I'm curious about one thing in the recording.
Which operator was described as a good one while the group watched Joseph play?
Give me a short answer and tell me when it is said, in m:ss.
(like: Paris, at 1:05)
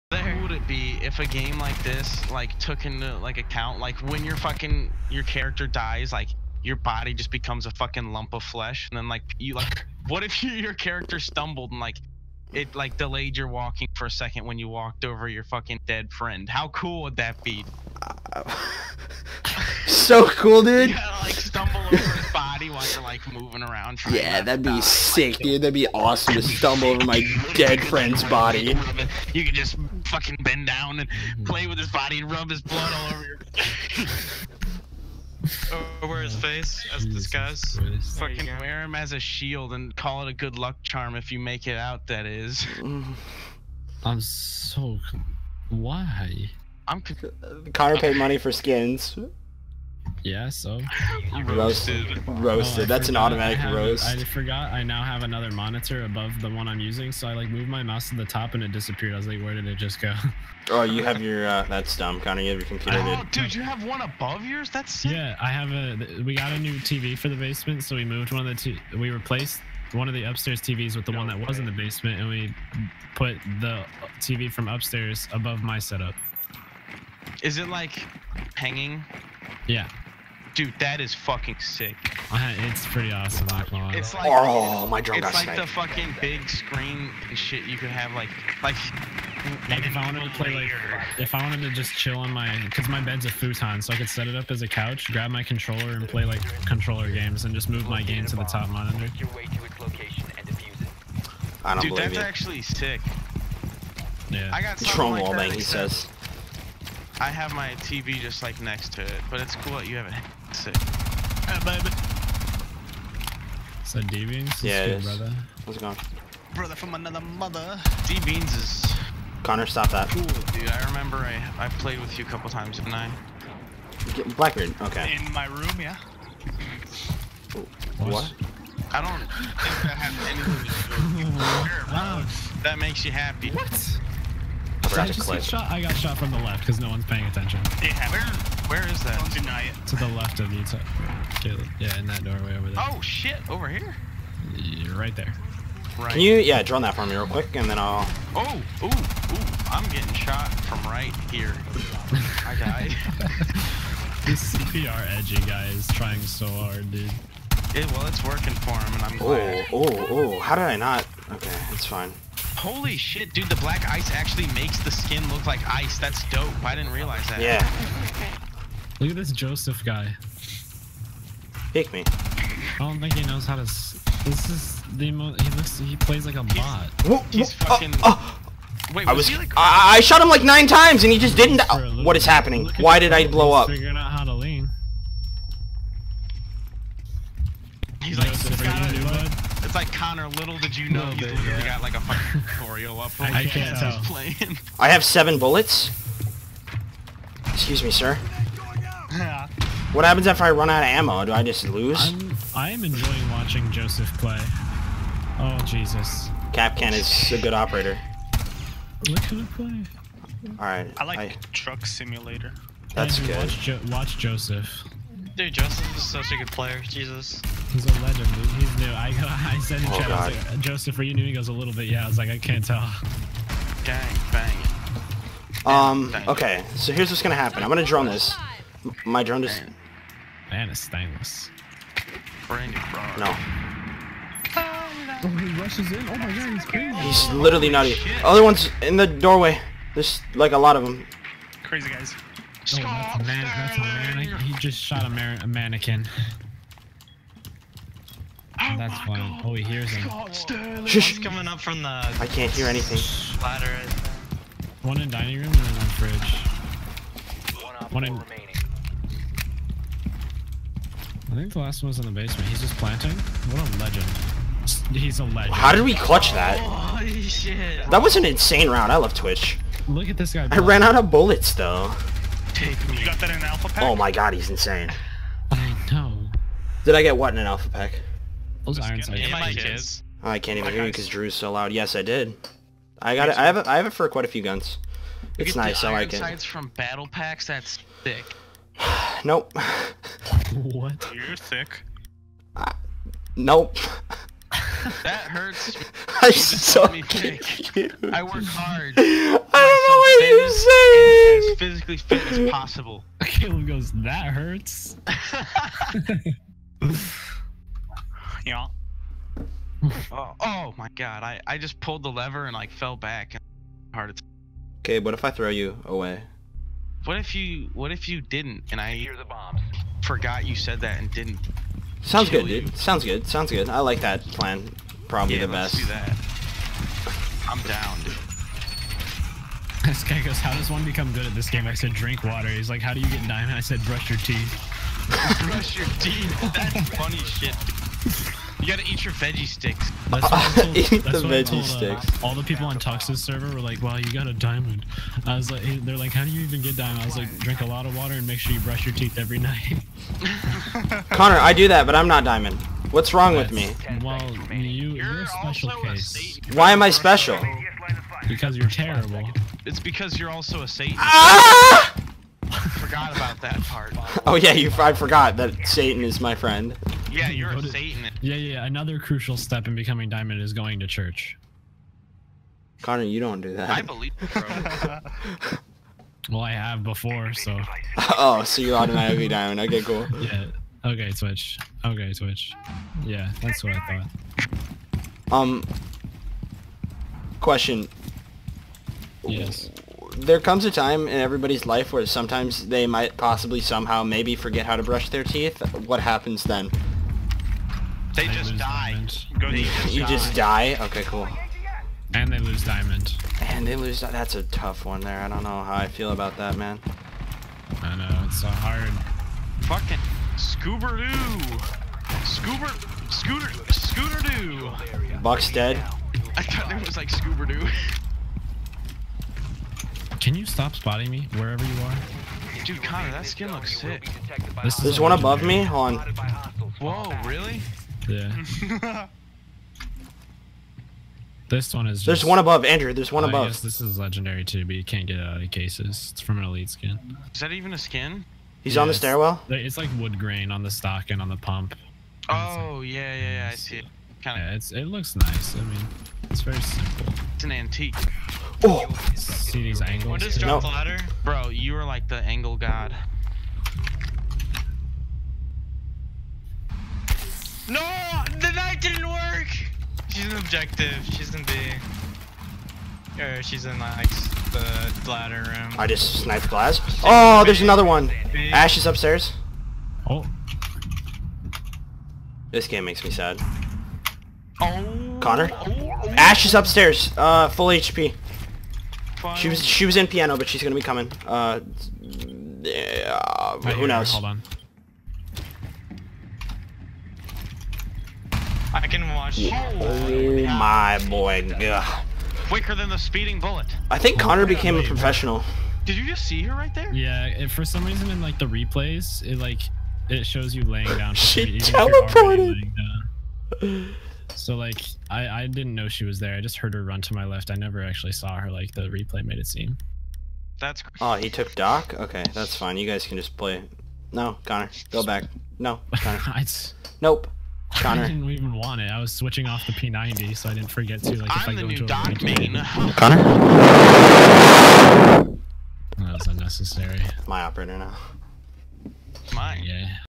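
Kapkan, at 3:26.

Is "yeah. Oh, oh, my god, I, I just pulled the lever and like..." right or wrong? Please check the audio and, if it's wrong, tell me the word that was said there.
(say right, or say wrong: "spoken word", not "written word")
right.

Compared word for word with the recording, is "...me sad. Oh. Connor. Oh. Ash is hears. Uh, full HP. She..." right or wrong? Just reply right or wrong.
wrong.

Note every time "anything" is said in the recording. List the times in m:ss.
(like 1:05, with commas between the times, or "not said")
2:10, 4:12.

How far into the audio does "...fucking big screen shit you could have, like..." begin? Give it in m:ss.
1:25.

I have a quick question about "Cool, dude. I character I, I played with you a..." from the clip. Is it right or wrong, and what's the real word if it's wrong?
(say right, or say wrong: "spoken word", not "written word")
wrong: "remember", not "character".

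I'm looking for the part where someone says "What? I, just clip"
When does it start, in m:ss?
2:13.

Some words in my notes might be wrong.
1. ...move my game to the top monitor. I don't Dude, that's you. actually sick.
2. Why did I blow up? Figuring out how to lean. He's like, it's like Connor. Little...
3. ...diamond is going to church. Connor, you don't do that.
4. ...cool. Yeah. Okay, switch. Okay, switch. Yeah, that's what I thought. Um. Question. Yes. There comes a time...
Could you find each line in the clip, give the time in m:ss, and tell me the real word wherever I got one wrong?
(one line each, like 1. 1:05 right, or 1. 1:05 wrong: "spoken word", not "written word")
1. 1:37 right
2. 3:02 right
3. 6:10 right
4. 6:19 right.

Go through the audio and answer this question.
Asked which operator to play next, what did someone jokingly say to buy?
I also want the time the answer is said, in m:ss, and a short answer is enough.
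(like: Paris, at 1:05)
Truck Simulator, at 3:31.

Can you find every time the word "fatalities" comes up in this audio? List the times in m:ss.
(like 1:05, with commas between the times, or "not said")
not said.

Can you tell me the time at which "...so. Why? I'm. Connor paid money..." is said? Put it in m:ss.
0:44.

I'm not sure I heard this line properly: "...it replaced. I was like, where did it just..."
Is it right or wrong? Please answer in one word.
wrong.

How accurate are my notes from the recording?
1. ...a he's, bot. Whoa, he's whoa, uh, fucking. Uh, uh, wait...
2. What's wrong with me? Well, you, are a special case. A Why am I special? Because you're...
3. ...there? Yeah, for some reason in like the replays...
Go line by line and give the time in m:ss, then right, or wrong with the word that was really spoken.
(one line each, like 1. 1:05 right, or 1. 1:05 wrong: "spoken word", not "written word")
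1. 2:56 right
2. 5:52 right
3. 8:16 right.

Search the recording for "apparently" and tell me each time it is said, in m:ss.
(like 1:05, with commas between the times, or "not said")
not said.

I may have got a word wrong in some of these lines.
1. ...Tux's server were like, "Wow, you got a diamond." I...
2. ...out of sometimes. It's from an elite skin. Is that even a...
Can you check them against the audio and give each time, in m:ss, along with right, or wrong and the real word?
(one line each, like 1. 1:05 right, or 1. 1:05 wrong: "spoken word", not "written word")
1. 5:42 right
2. 7:15 wrong: "cases", not "sometimes".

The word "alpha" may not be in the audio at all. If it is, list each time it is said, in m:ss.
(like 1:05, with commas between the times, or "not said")
4:33, 4:37.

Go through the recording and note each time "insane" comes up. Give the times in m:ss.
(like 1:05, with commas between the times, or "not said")
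4:28, 4:34.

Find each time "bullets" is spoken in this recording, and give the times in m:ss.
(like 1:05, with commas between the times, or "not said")
3:15, 4:31, 8:13.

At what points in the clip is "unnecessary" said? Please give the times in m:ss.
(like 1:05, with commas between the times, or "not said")
8:46.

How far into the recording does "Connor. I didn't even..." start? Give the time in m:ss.
8:37.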